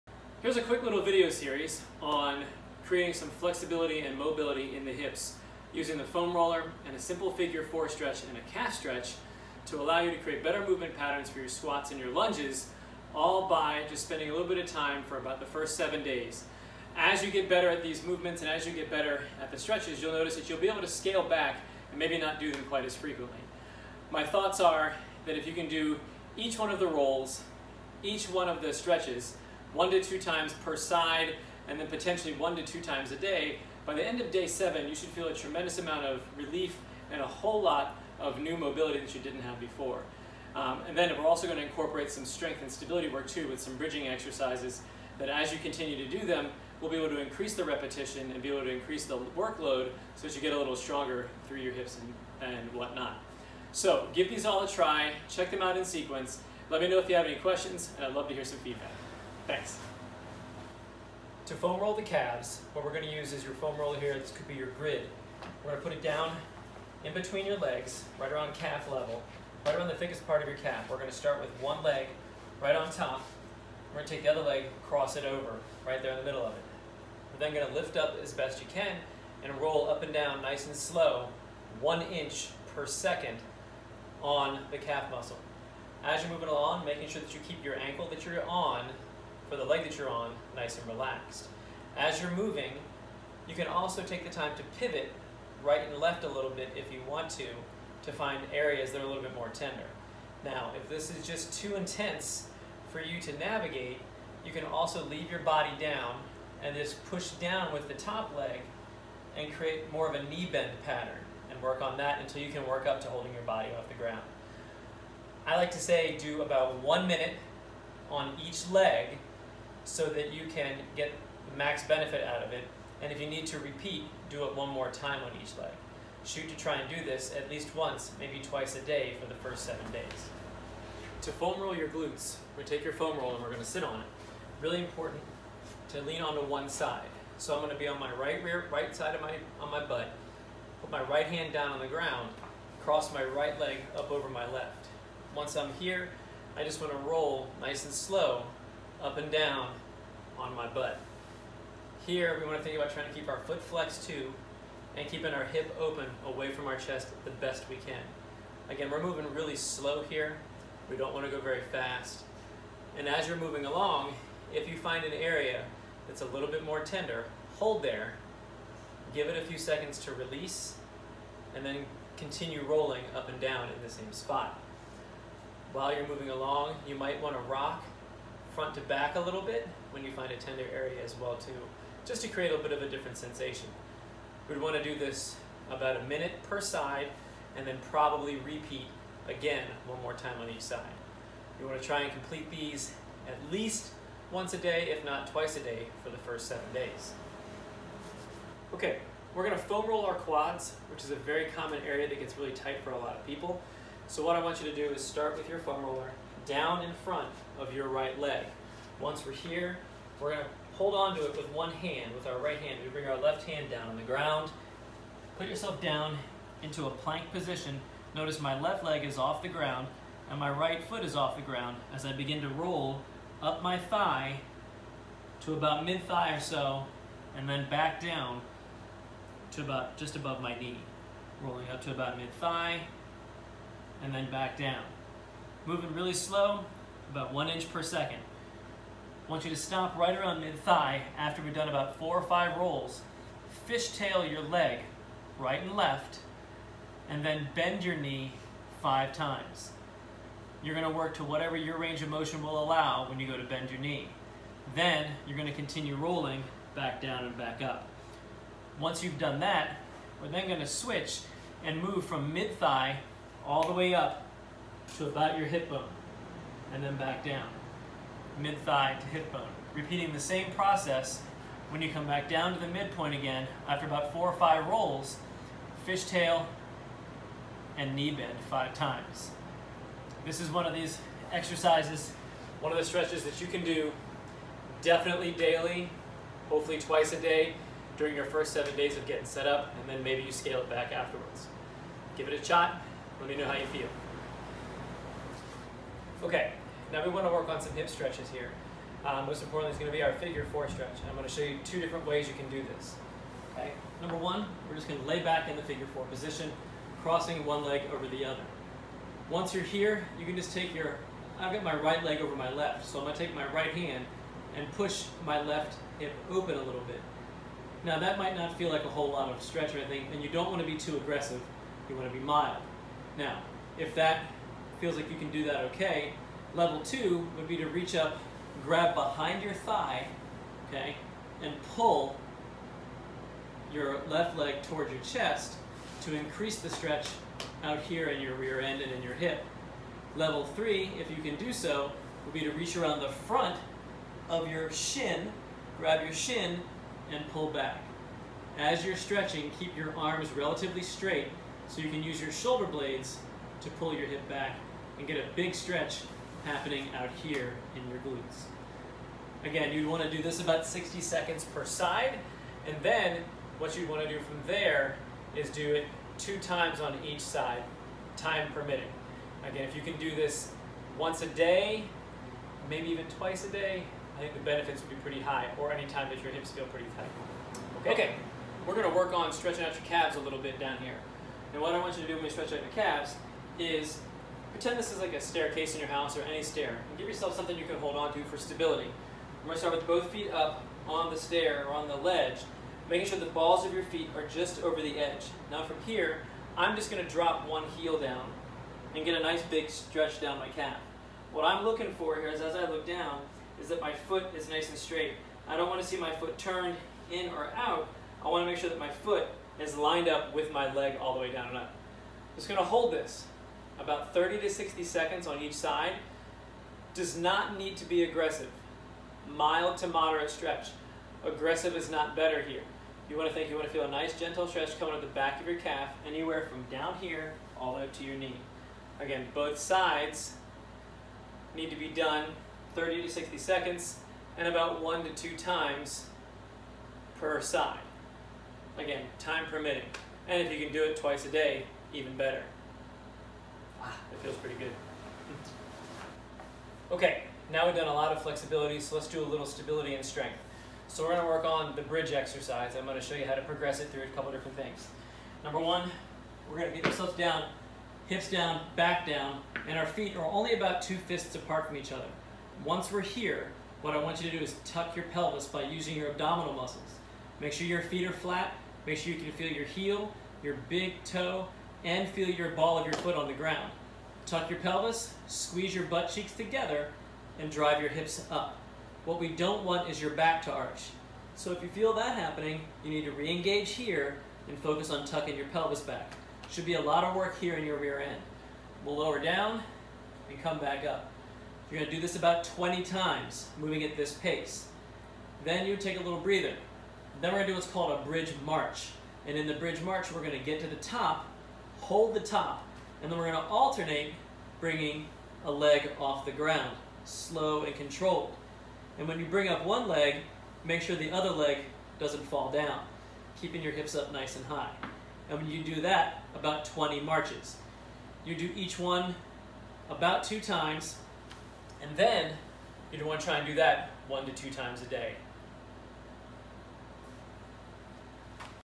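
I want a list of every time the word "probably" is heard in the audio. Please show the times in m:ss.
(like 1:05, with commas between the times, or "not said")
3:07.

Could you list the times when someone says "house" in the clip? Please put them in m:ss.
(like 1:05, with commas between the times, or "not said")
6:25.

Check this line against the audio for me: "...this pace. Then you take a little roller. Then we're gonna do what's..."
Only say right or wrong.
wrong.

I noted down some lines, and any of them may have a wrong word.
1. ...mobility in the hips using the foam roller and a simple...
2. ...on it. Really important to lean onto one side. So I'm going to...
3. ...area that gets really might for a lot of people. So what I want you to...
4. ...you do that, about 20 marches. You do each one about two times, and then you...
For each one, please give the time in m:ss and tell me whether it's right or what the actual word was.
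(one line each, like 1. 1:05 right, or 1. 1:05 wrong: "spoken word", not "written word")
1. 0:04 right
2. 2:13 right
3. 3:21 wrong: "tight", not "might"
4. 8:35 right.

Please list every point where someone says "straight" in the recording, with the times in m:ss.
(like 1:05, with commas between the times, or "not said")
5:50, 6:44.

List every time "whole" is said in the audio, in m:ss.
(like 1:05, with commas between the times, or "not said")
0:37, 5:18.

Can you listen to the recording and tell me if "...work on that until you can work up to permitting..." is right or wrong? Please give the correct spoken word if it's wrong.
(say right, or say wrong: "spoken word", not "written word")
wrong: "holding", not "permitting".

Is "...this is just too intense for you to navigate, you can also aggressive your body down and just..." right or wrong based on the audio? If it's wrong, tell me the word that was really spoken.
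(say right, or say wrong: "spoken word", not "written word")
wrong: "leave", not "aggressive".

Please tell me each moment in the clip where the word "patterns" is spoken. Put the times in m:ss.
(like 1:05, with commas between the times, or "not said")
0:10, 1:50.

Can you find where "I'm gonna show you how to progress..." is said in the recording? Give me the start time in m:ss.
7:32.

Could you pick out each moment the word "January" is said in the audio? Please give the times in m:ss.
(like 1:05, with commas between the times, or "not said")
not said.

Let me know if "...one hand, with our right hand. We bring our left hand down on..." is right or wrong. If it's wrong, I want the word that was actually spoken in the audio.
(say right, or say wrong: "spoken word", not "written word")
right.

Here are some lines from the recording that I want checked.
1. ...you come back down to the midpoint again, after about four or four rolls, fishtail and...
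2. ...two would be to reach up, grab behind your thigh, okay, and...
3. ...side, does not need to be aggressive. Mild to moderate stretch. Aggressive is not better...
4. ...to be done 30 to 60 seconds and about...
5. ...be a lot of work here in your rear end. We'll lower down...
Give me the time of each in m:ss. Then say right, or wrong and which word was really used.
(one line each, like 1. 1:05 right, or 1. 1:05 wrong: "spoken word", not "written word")
1. 4:31 wrong: "five", not "four"
2. 5:26 right
3. 6:55 right
4. 7:11 right
5. 8:06 right.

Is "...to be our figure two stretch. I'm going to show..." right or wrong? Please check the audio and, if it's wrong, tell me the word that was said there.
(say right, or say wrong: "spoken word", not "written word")
wrong: "four", not "two".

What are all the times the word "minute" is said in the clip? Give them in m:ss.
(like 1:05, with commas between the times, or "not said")
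1:57, 3:06.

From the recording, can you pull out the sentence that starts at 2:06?
Shoot to try and do this at least once, maybe twice a day for the first seven days.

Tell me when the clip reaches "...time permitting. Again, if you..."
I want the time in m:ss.
6:08.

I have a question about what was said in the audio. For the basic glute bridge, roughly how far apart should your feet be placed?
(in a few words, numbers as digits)
2 fists.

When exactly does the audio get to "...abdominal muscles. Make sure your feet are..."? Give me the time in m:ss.
7:46.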